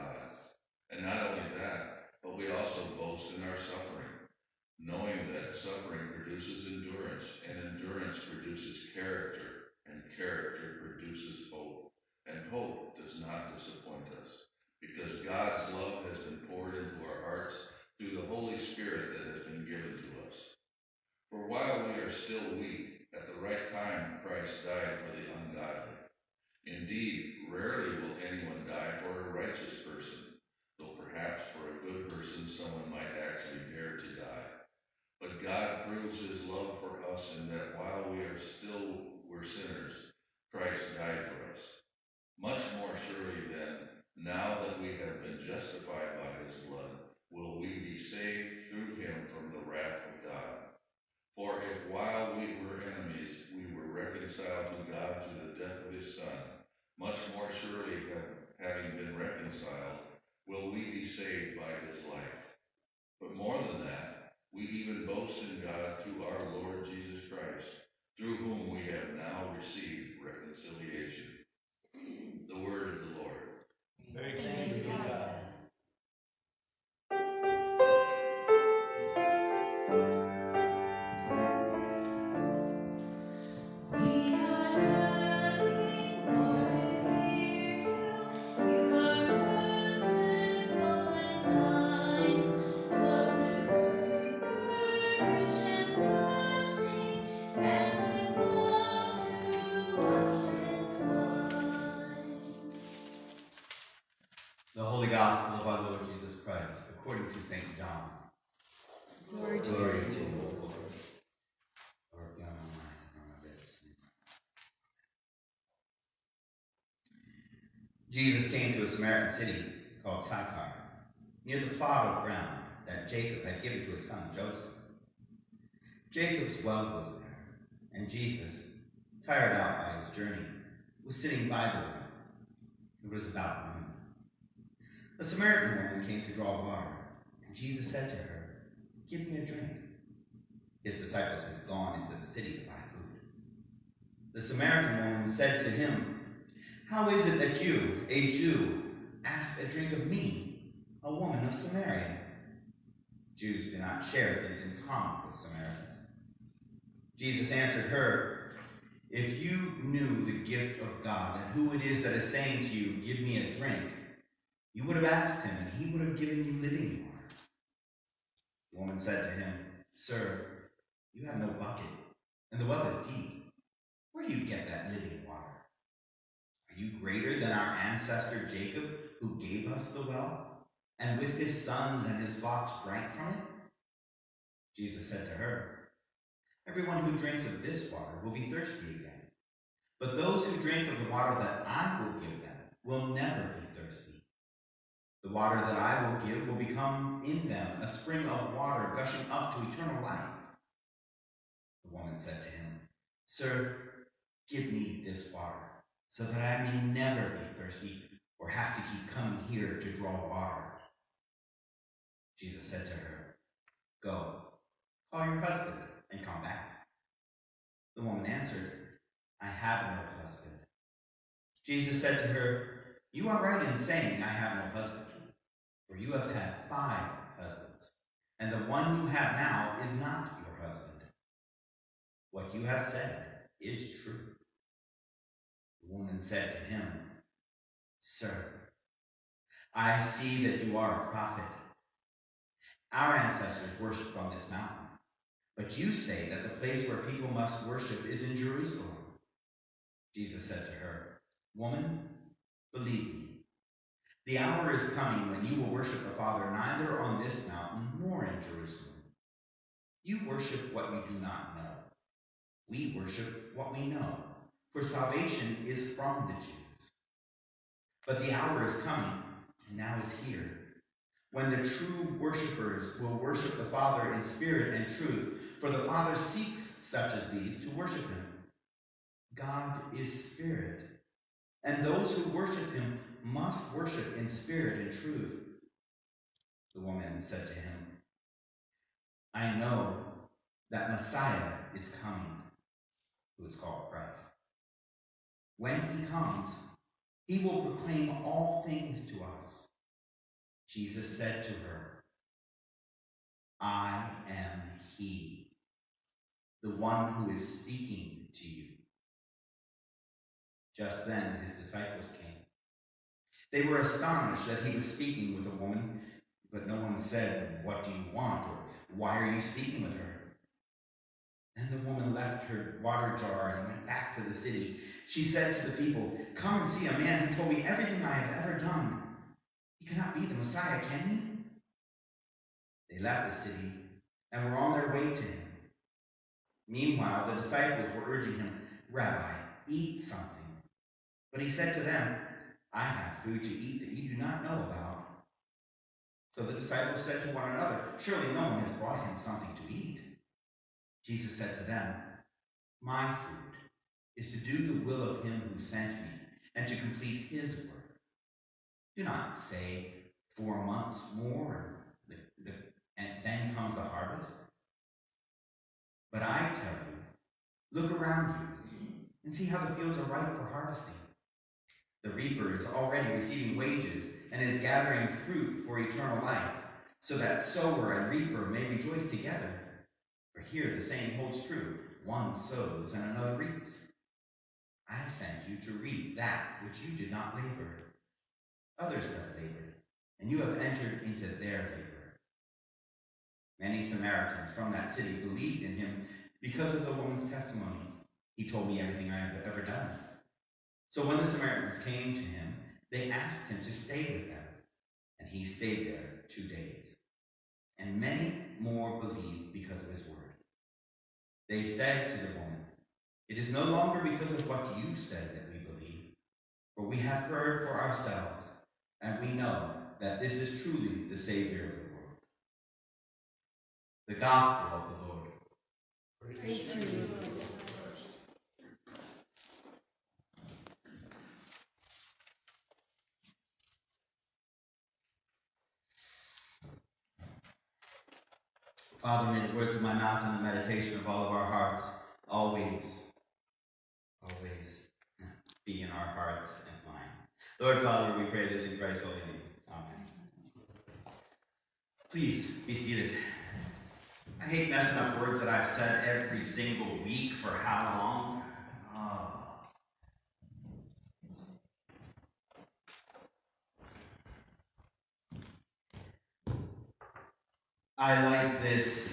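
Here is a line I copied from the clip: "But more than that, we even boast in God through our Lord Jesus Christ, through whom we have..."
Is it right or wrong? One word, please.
right.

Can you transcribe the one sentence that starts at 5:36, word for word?
Meanwhile, the disciples were urging him, Rabbi, eat something.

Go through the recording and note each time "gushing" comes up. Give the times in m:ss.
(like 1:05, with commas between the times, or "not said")
3:18.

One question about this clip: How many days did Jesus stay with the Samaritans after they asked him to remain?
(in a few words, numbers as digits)
2 days.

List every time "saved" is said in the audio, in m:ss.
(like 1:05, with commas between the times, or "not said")
0:47, 1:01.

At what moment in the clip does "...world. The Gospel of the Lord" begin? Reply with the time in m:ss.
7:01.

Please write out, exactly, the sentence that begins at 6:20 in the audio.
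For here the saying holds true one sows and another reaps.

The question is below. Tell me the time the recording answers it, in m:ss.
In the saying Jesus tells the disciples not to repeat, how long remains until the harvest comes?
6:00.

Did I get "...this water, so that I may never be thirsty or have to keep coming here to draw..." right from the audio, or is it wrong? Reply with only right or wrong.
right.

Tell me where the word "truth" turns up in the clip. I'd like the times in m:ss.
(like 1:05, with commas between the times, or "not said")
4:34, 4:44.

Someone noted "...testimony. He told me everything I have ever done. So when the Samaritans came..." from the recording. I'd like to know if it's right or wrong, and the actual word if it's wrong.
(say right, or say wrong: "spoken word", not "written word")
right.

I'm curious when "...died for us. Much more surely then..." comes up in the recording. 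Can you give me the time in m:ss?
0:40.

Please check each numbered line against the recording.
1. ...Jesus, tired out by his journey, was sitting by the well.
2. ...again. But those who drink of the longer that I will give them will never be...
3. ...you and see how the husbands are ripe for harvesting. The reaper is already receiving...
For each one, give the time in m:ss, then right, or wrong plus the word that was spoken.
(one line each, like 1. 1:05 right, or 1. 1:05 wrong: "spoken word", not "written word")
1. 2:08 right
2. 3:08 wrong: "water", not "longer"
3. 6:08 wrong: "fields", not "husbands".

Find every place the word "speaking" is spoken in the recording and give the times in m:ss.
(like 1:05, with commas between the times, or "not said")
5:07, 5:14, 5:19.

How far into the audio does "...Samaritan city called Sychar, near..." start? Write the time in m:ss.
1:59.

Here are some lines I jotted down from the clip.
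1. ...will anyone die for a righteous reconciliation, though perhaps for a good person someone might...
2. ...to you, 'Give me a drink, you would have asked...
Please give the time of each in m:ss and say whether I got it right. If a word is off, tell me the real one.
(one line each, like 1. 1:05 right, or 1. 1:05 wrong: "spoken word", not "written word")
1. 0:27 wrong: "person", not "reconciliation"
2. 2:42 right.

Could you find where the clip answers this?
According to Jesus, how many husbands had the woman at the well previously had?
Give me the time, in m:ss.
3:46.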